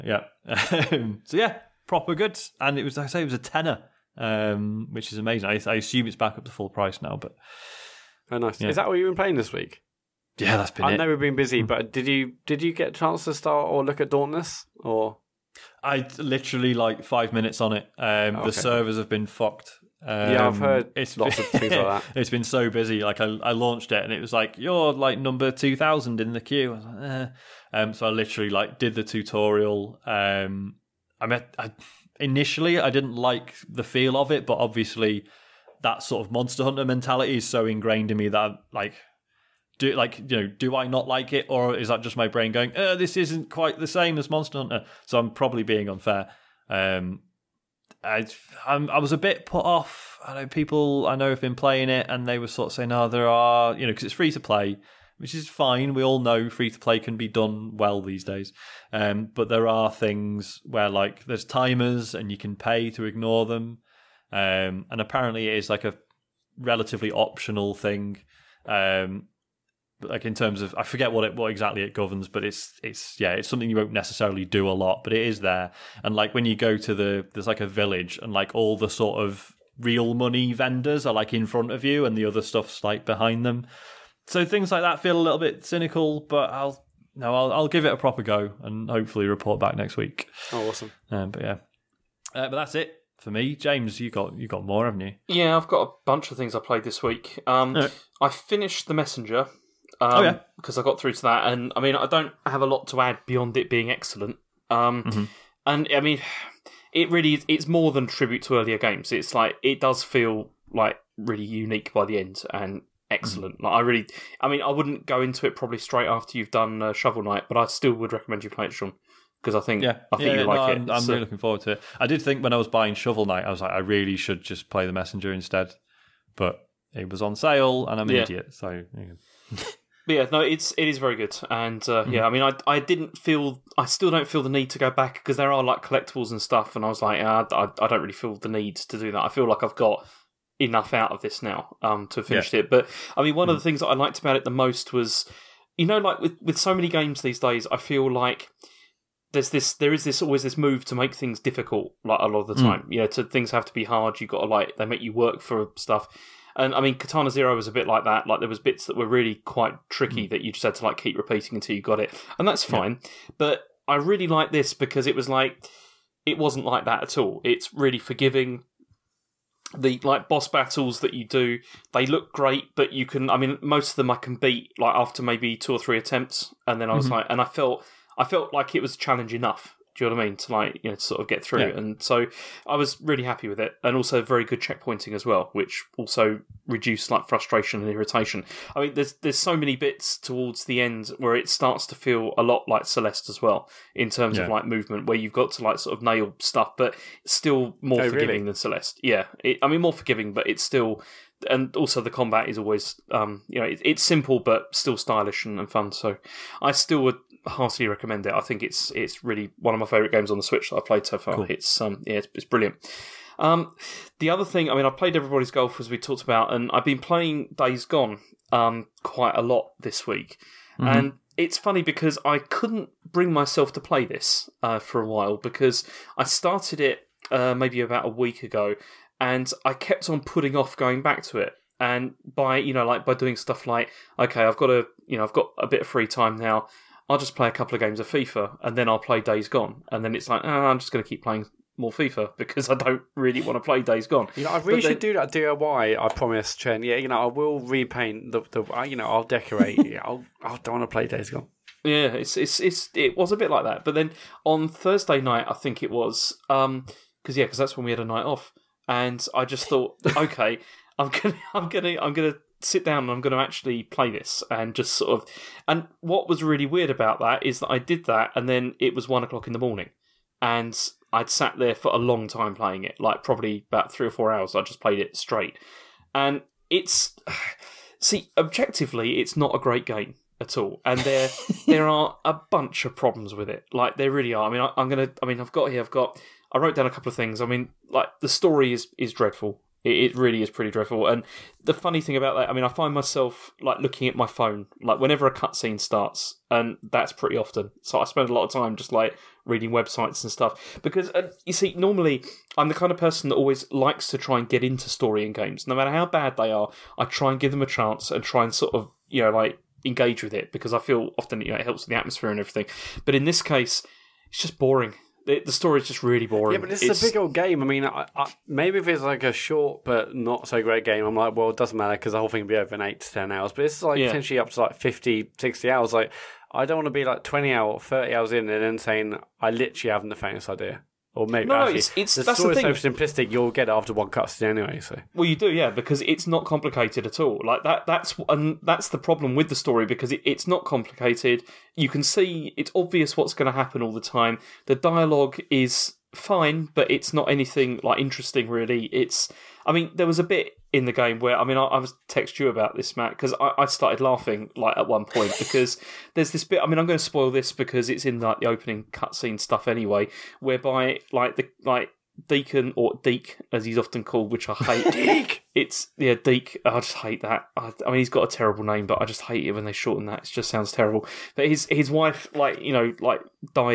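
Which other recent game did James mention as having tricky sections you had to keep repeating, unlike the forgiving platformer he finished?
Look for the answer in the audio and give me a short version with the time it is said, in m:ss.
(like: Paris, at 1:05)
Katana Zero, at 2:36.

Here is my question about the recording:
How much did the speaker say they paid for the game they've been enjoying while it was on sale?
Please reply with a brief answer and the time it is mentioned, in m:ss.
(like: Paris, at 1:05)
a tenner, at 0:03.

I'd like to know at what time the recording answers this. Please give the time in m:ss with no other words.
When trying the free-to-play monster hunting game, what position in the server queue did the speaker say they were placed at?
0:25.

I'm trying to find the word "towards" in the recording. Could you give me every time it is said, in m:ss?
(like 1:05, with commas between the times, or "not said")
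3:10.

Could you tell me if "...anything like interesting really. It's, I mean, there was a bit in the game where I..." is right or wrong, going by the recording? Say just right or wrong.
right.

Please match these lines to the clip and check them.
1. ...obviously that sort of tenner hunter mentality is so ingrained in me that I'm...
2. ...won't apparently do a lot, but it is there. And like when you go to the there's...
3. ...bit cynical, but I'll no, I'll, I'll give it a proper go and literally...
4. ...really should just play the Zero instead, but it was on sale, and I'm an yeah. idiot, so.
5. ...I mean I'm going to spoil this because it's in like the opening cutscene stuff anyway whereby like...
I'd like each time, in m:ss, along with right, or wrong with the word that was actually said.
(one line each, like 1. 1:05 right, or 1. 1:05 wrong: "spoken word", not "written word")
1. 0:34 wrong: "monster", not "tenner"
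2. 1:13 wrong: "necessarily", not "apparently"
3. 1:25 wrong: "hopefully", not "literally"
4. 2:03 wrong: "Messenger", not "Zero"
5. 5:56 right.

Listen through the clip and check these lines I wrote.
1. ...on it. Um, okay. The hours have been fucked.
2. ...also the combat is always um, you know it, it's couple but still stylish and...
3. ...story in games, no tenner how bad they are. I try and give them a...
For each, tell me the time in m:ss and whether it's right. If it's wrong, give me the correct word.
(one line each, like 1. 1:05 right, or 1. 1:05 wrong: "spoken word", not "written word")
1. 0:17 wrong: "servers", not "hours"
2. 3:21 wrong: "simple", not "couple"
3. 5:04 wrong: "matter", not "tenner".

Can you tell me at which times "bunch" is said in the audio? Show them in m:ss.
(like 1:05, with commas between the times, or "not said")
1:36, 4:42.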